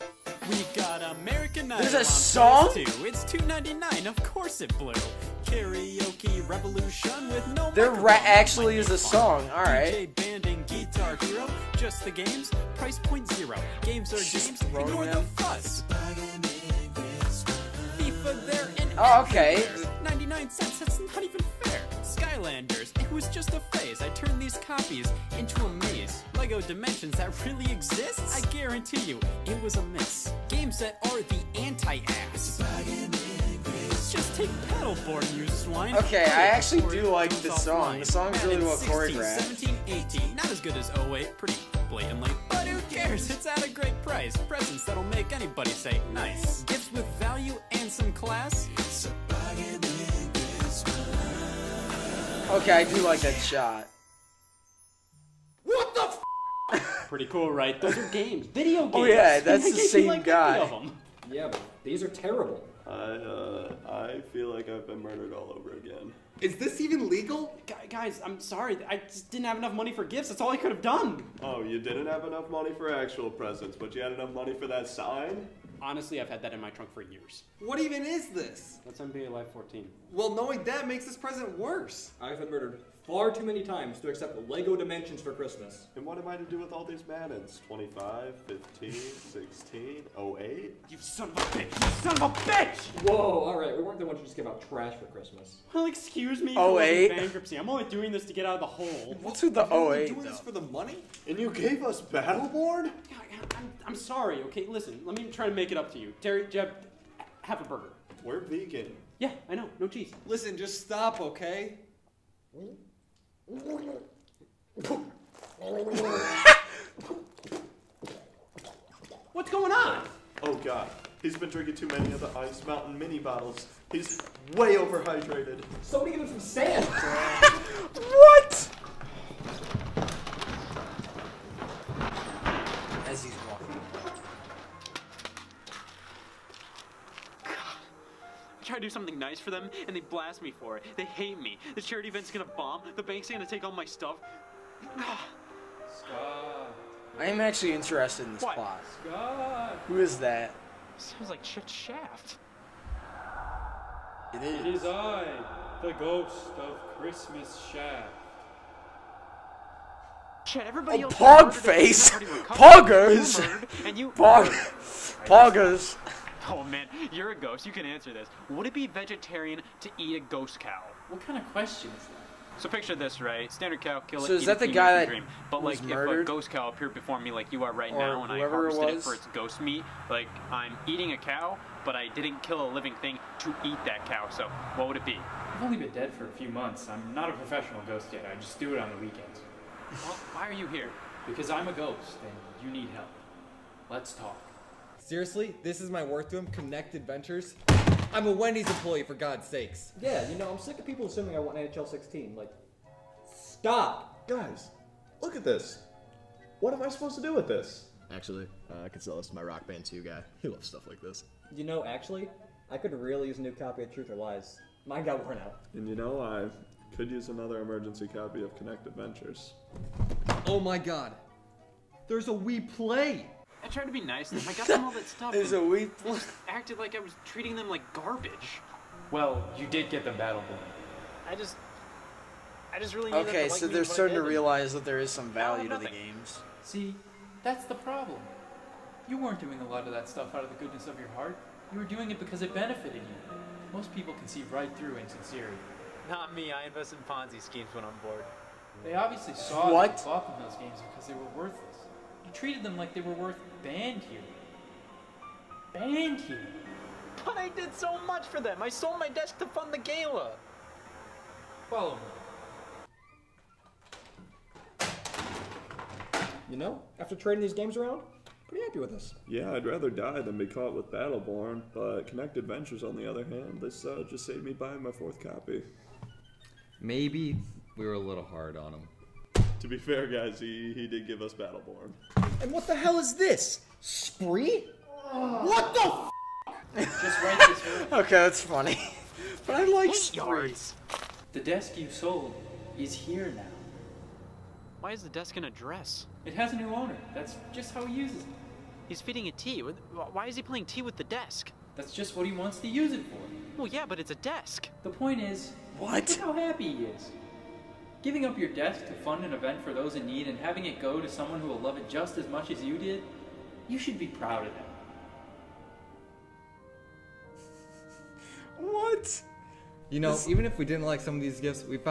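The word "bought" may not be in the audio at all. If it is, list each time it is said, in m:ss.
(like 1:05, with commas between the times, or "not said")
4:10.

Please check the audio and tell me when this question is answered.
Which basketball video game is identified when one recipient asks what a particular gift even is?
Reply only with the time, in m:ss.
1:18.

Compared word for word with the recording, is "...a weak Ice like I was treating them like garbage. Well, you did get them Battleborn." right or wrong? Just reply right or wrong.
wrong.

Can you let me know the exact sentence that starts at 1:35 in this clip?
Well, excuse me for oh bankruptcy.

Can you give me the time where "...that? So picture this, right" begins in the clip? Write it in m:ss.
2:52.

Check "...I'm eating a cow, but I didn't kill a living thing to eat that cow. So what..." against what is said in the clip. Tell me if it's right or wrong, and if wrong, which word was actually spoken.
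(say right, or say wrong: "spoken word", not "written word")
right.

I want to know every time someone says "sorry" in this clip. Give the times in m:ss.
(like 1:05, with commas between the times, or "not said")
1:08, 1:43.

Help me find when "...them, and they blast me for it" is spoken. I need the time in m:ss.
2:19.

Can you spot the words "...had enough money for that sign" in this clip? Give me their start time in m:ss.
1:14.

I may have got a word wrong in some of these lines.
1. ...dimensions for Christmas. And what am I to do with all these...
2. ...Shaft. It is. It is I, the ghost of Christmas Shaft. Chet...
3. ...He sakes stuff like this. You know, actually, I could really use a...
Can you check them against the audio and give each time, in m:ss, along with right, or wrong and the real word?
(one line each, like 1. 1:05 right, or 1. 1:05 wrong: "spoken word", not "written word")
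1. 1:24 right
2. 2:31 right
3. 3:30 wrong: "loves", not "sakes".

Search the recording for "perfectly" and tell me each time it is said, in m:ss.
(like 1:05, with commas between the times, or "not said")
not said.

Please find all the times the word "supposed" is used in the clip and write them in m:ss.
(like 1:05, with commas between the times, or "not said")
3:26.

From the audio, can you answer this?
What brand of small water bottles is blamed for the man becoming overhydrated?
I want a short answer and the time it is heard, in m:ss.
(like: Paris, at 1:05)
Ice Mountain, at 2:02.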